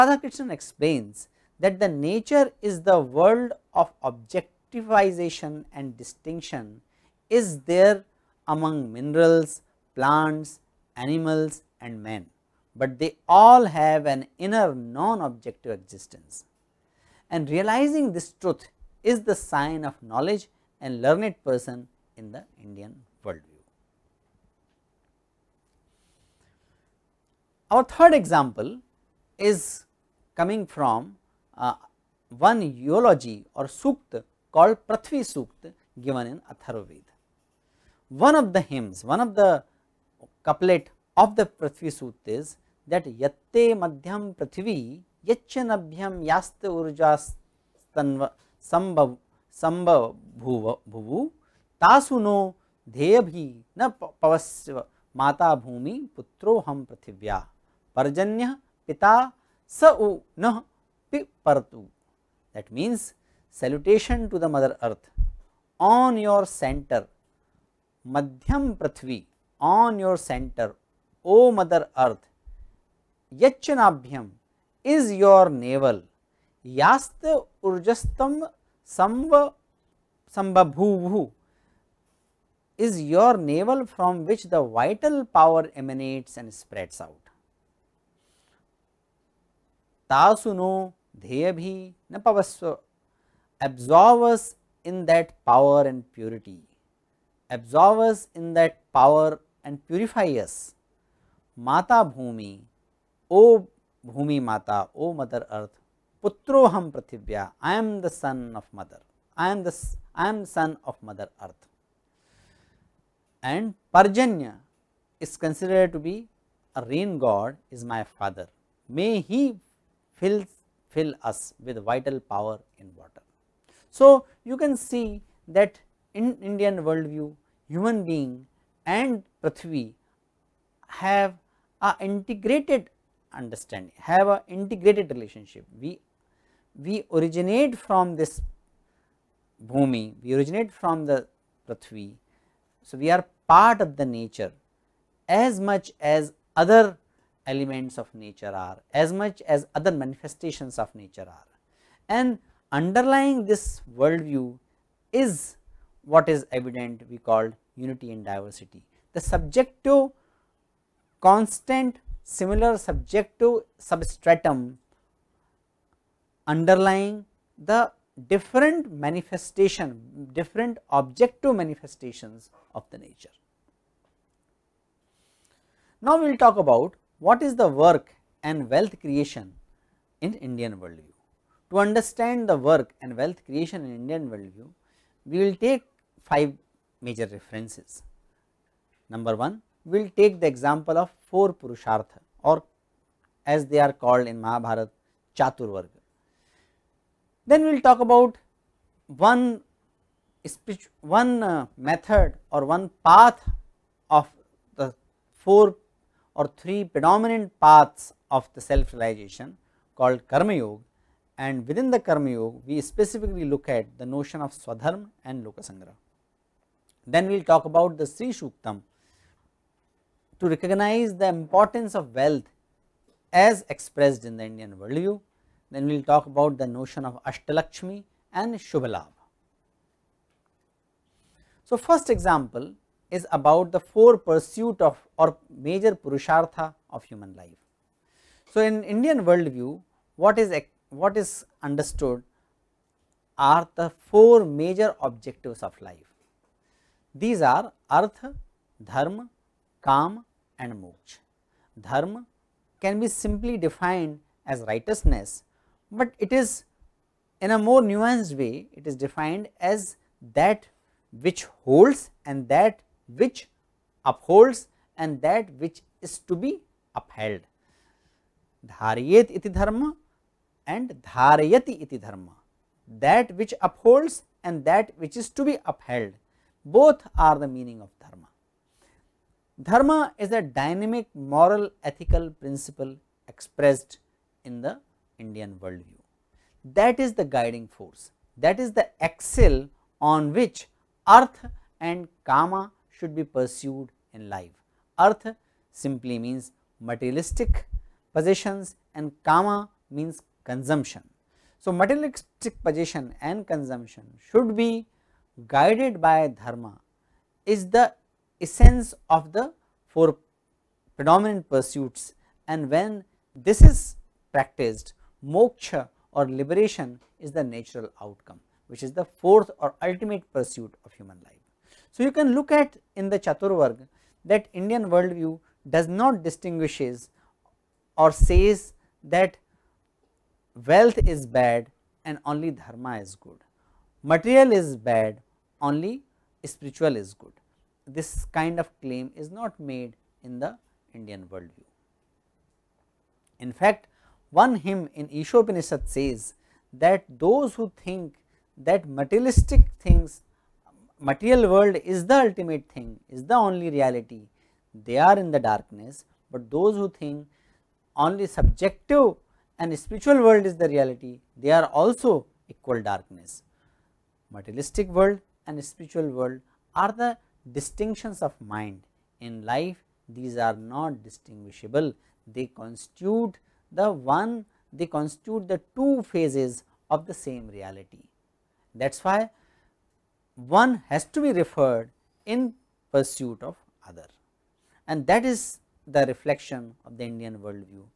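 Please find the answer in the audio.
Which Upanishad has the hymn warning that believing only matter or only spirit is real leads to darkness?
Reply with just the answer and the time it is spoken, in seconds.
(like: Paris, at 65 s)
Ishopanishad, at 345 s.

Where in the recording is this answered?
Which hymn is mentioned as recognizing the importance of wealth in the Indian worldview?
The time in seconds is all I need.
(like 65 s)
218 s.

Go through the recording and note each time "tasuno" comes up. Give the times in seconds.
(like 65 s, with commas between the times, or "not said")
51 s, 90 s.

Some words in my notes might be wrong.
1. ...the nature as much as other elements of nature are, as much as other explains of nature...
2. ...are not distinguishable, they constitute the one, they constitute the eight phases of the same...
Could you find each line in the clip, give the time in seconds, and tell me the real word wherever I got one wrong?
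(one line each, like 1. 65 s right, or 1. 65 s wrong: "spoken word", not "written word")
1. 143 s wrong: "manifestations", not "explains"
2. 370 s wrong: "two", not "eight".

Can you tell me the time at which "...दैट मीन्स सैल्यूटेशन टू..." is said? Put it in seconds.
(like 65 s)
62 s.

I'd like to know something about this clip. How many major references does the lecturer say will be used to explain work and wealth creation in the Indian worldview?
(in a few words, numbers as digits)
5.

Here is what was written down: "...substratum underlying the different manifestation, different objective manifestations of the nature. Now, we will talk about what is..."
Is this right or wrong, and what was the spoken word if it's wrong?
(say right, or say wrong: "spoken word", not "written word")
right.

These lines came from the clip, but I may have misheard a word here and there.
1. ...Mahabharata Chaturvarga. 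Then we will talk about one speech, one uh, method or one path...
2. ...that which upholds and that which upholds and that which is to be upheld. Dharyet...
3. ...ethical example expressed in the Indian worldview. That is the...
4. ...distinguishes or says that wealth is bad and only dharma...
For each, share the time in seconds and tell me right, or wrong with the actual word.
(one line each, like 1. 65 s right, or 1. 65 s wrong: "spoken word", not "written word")
1. 194 s right
2. 260 s wrong: "holds", not "upholds"
3. 281 s wrong: "principle", not "example"
4. 326 s right.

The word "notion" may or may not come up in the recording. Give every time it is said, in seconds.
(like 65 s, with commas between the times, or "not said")
214 s, 226 s.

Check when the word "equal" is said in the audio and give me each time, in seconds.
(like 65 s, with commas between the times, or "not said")
362 s.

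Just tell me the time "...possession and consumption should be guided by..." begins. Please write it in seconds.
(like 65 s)
302 s.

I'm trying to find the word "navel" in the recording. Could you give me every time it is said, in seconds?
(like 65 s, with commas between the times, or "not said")
75 s, 83 s.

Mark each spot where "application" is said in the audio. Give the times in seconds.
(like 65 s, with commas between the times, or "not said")
not said.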